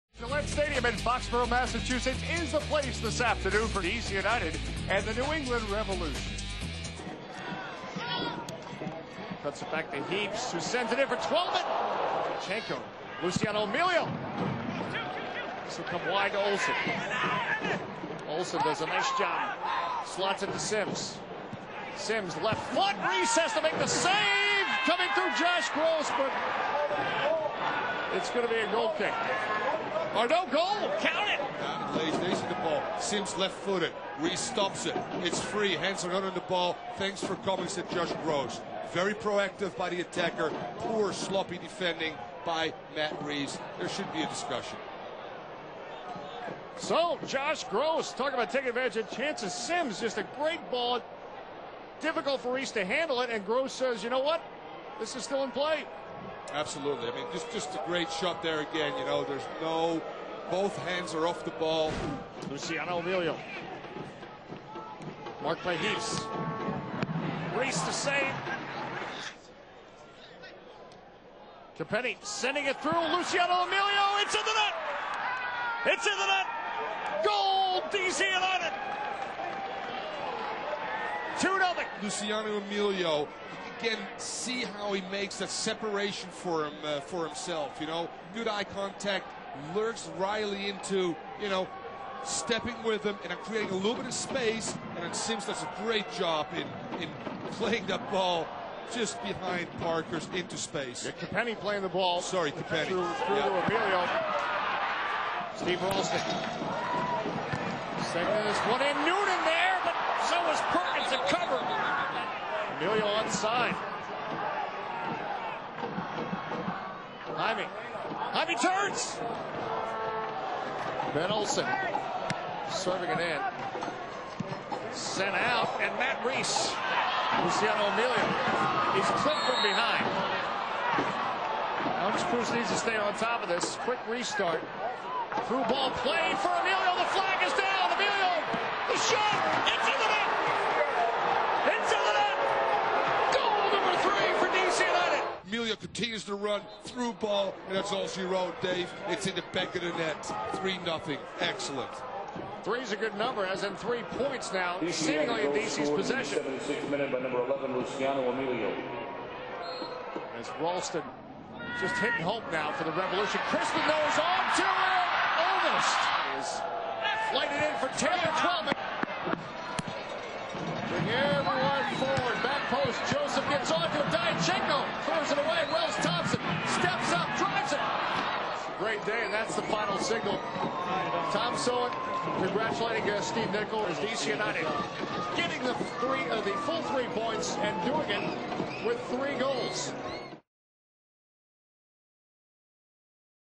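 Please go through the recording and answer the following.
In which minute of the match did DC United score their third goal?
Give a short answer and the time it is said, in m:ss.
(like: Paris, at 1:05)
76, at 2:36.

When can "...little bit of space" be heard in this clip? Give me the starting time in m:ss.
1:33.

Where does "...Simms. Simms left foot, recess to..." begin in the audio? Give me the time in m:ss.
0:20.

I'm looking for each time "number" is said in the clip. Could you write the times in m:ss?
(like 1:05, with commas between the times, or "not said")
2:33, 2:37.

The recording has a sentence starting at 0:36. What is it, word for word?
Thanks for coming, said Josh Gros.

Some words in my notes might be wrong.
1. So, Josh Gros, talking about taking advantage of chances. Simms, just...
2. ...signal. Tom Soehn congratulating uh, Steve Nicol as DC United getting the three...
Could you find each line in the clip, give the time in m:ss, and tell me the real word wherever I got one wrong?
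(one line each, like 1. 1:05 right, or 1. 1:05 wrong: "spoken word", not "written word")
1. 0:46 right
2. 2:59 right.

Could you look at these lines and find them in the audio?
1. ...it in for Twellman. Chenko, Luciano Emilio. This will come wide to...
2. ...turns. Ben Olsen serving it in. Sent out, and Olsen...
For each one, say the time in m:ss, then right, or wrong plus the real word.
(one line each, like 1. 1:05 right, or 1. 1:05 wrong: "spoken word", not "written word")
1. 0:10 right
2. 1:58 wrong: "Matt", not "Olsen".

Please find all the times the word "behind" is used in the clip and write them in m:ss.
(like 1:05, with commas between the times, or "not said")
1:39, 2:09.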